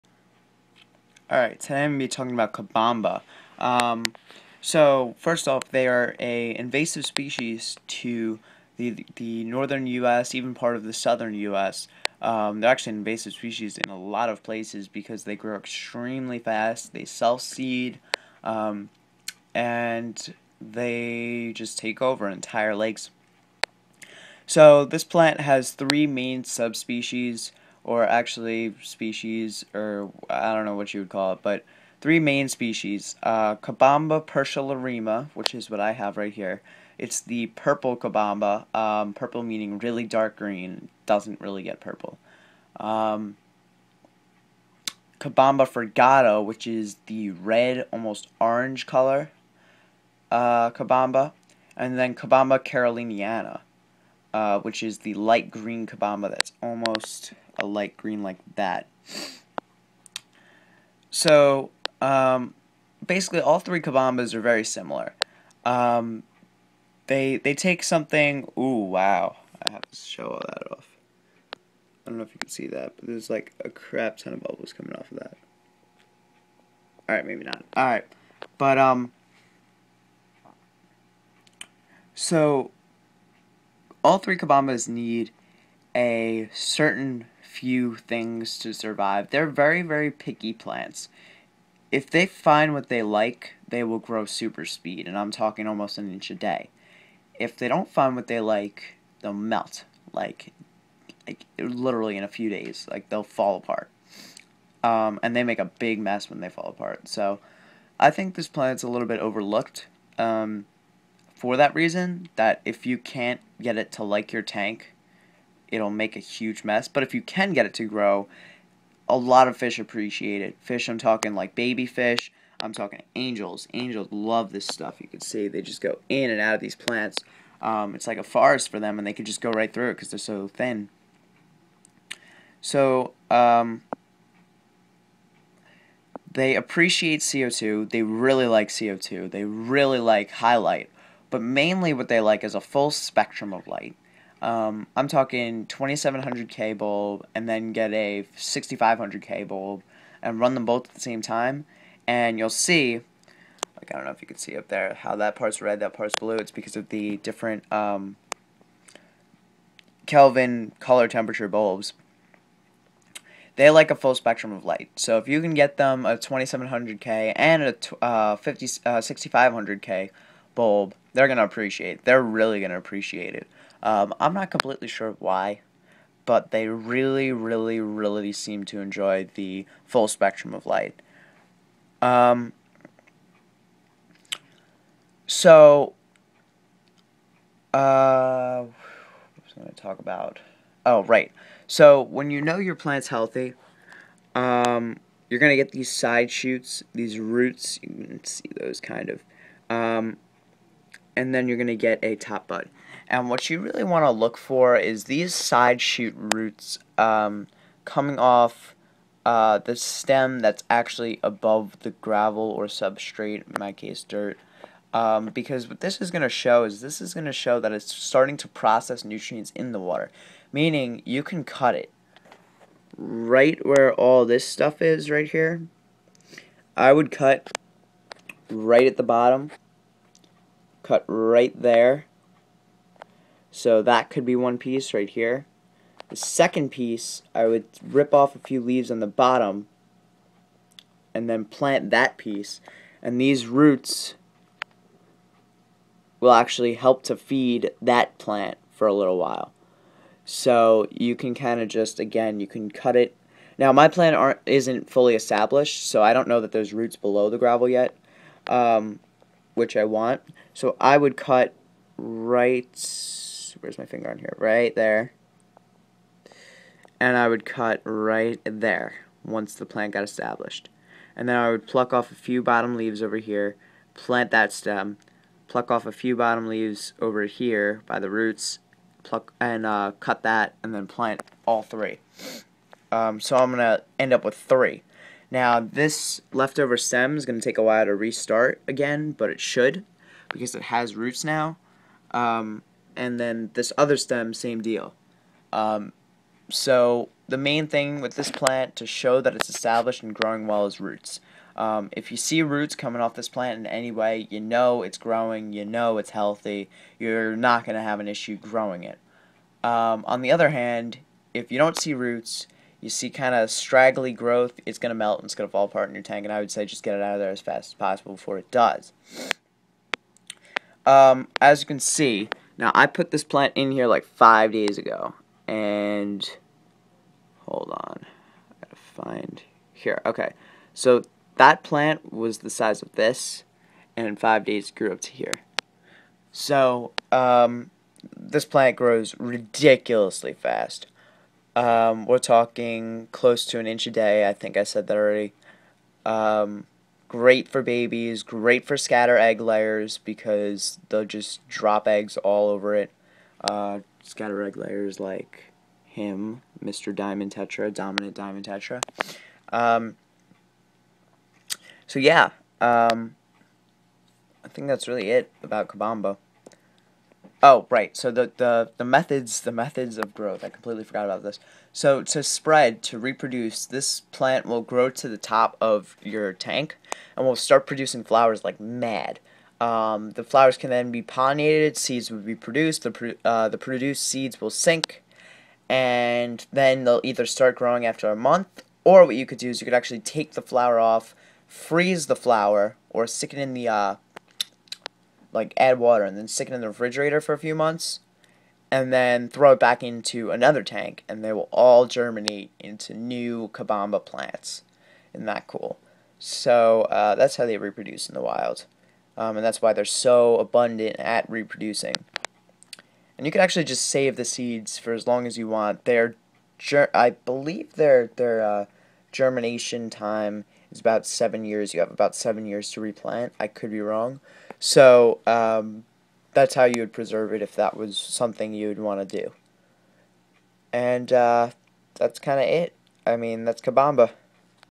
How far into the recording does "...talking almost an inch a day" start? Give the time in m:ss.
1:35.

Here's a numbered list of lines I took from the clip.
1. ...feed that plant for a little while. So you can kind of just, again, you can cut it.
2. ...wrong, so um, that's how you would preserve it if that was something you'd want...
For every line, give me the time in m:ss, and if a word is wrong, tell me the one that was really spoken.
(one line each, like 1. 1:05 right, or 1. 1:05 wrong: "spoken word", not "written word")
1. 4:07 right
2. 7:03 right.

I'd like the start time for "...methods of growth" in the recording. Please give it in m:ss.
6:09.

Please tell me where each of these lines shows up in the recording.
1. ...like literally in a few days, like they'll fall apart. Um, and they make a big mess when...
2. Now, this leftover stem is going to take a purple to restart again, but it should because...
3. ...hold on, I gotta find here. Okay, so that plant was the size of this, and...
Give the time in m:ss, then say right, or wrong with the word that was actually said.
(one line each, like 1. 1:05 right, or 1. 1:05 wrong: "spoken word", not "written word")
1. 1:41 right
2. 4:45 wrong: "while", not "purple"
3. 5:27 right.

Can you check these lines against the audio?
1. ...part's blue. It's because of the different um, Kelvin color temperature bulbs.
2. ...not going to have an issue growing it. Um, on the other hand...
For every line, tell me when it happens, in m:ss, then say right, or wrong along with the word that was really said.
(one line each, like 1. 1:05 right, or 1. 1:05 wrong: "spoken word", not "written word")
1. 2:35 right
2. 5:07 right.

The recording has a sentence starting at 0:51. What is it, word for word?
And then Cabomba caroliniana, uh, which is the light green Cabomba that's almost a light green like that.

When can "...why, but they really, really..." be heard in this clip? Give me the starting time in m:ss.
2:55.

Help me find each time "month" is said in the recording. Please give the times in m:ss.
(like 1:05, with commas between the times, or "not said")
6:28, 6:37.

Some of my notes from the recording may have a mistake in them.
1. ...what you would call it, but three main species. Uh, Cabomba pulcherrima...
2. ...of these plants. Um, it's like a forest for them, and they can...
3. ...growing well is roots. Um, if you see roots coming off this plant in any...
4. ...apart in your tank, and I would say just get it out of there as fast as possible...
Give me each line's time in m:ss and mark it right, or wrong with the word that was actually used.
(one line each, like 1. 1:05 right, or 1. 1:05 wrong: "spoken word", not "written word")
1. 0:30 right
2. 2:06 right
3. 5:00 right
4. 5:15 right.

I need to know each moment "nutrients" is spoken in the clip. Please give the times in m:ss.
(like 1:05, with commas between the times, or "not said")
3:39.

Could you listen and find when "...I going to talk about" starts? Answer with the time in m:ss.
3:09.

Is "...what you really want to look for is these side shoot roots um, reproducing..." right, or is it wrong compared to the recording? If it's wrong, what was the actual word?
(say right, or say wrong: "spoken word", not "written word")
wrong: "coming", not "reproducing".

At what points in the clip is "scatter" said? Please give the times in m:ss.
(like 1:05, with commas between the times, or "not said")
5:48, 5:54.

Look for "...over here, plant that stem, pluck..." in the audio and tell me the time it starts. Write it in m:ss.
4:33.